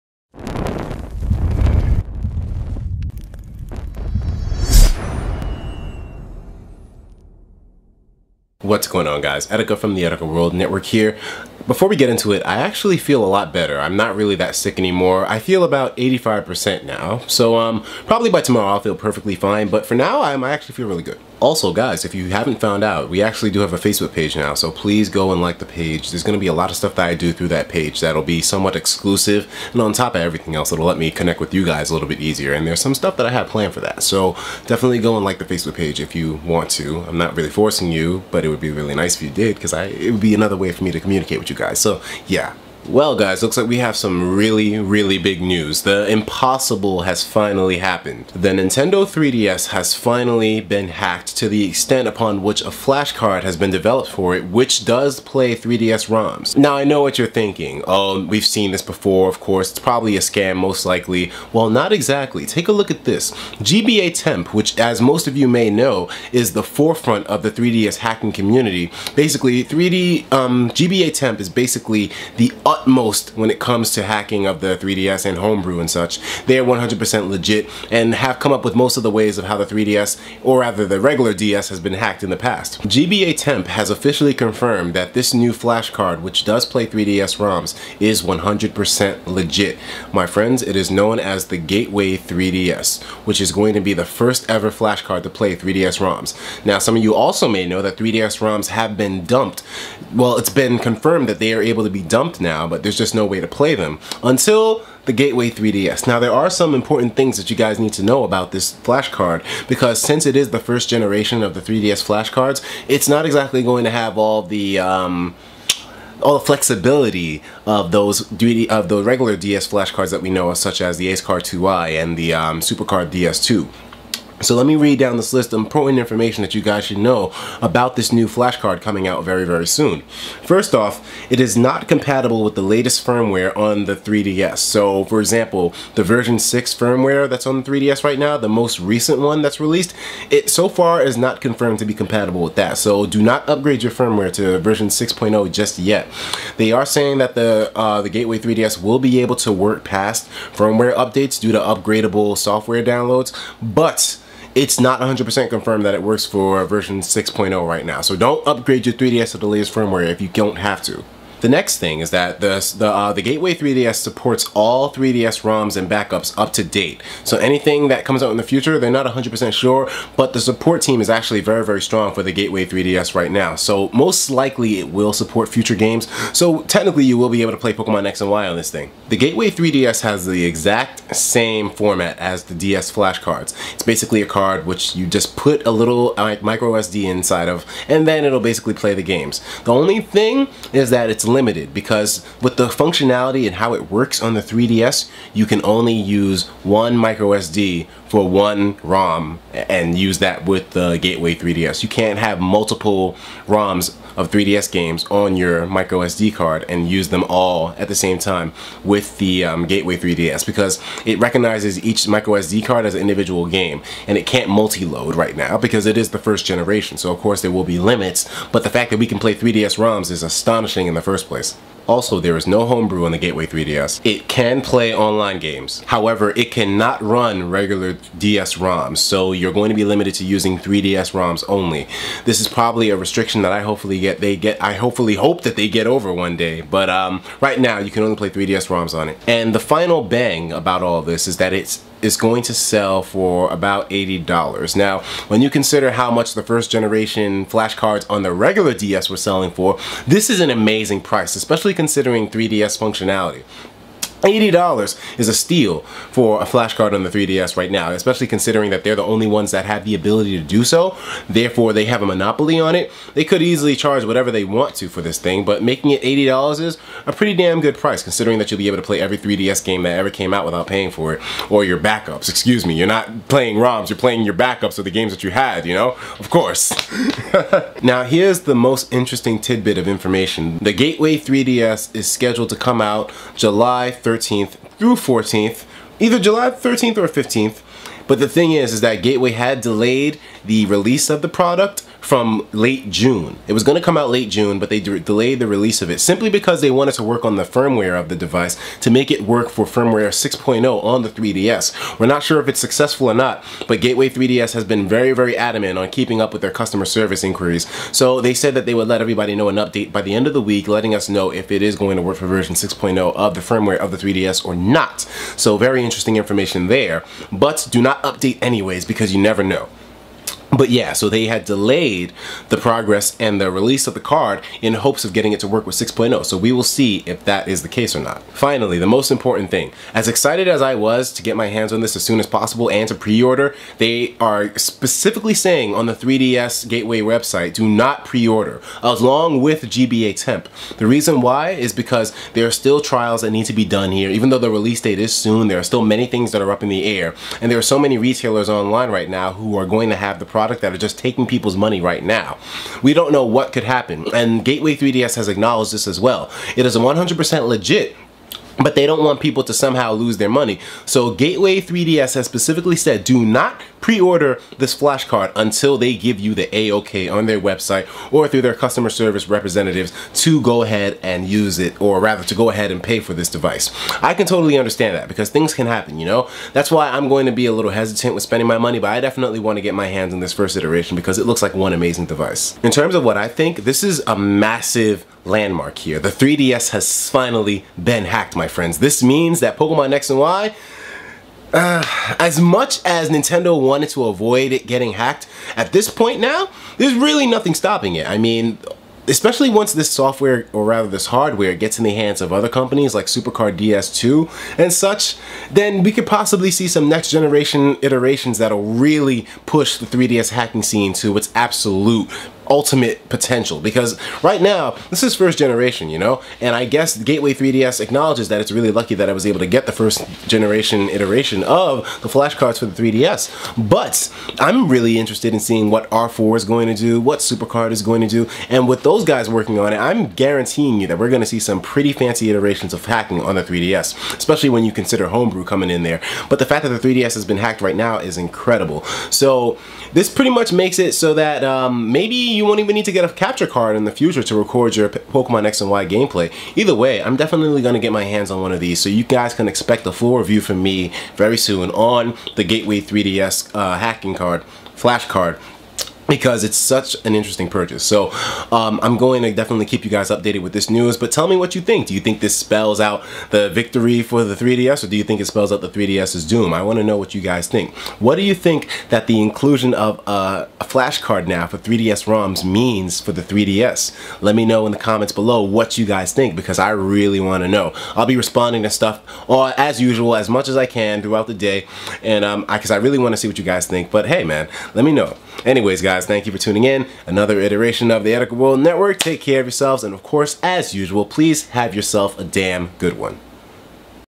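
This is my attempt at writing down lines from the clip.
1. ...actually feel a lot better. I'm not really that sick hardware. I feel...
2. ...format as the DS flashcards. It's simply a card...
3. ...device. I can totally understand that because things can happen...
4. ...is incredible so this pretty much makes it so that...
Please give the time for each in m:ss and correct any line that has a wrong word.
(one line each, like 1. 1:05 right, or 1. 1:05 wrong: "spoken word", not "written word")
1. 0:12 wrong: "anymore", not "hardware"
2. 3:01 wrong: "basically", not "simply"
3. 6:13 right
4. 7:17 right.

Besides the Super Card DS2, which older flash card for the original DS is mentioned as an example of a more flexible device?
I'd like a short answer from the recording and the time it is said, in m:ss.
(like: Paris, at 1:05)
Acekard 2i, at 2:01.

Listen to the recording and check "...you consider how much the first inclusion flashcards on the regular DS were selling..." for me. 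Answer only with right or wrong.
wrong.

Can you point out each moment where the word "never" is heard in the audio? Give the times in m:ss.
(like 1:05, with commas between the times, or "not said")
5:19.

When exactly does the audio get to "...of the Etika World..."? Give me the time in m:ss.
8:07.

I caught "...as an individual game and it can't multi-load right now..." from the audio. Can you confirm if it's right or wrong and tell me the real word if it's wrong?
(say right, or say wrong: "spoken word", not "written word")
right.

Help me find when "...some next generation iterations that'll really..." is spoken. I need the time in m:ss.
6:46.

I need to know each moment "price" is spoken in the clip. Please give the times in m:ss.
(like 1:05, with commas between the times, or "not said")
4:11, 4:27.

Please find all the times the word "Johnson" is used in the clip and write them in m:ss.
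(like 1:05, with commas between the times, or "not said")
not said.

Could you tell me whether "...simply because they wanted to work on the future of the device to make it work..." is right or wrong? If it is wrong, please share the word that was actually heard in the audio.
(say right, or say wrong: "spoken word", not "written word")
wrong: "firmware", not "future".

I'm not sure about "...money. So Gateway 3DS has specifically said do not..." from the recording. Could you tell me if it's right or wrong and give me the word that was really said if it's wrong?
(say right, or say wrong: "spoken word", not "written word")
right.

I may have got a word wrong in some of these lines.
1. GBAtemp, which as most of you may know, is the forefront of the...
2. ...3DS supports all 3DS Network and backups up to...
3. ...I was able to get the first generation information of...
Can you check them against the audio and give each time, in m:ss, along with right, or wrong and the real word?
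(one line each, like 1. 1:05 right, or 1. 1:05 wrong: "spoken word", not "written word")
1. 1:03 right
2. 2:43 wrong: "ROMs", not "Network"
3. 6:59 wrong: "iteration", not "information".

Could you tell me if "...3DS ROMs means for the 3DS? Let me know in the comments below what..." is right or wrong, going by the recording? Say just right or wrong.
right.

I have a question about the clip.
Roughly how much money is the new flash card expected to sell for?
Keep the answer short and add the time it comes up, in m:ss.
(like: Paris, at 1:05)
$80, at 4:01.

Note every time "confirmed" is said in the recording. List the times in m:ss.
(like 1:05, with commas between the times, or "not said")
1:24, 1:40, 2:21, 2:35.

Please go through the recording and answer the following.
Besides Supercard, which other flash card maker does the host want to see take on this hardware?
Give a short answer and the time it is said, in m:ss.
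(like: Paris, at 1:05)
R4, at 7:05.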